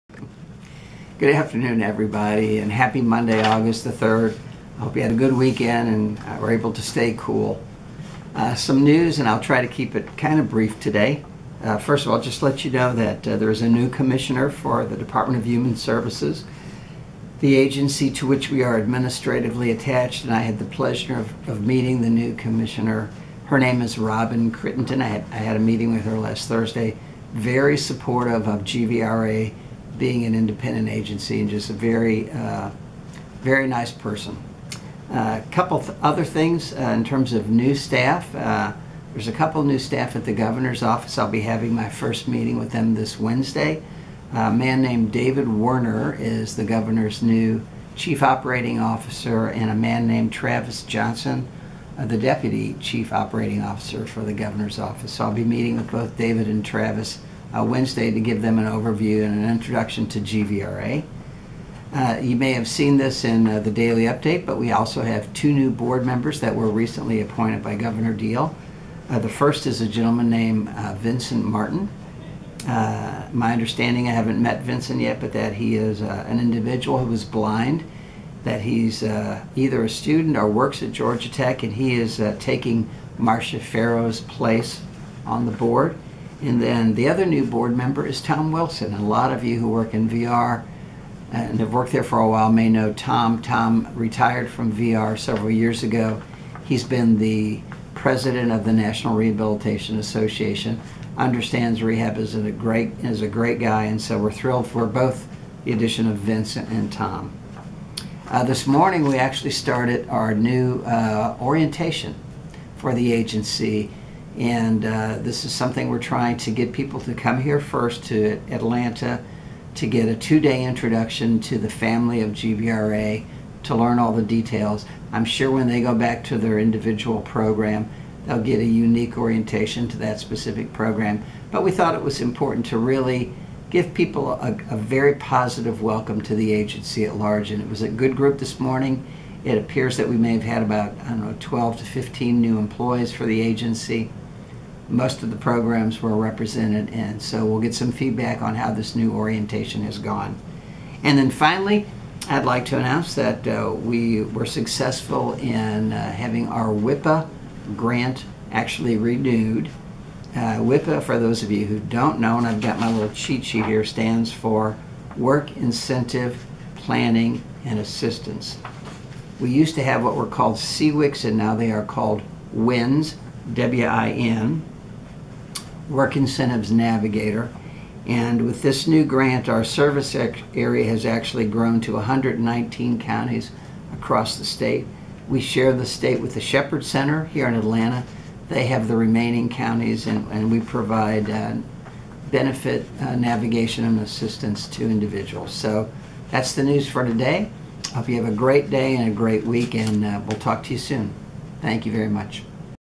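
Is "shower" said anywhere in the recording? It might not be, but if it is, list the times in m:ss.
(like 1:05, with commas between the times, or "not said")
not said.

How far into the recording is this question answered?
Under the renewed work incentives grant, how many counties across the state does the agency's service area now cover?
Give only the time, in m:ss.
3:01.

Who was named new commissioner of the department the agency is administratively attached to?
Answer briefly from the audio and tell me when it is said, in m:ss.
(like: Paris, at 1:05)
Robyn Crittenden, at 0:23.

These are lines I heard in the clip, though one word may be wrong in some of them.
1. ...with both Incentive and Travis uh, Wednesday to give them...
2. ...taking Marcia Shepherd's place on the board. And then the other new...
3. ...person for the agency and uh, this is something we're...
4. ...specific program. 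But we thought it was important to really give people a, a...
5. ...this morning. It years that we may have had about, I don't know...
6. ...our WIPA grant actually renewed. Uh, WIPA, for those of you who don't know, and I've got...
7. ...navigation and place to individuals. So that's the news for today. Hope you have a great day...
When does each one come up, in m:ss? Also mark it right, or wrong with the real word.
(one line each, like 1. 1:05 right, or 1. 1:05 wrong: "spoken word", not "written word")
1. 0:55 wrong: "David", not "Incentive"
2. 1:22 wrong: "Farrow", not "Shepherd"
3. 1:51 wrong: "orientation", not "person"
4. 2:10 right
5. 2:18 wrong: "appears", not "years"
6. 2:36 right
7. 3:13 wrong: "assistance", not "place".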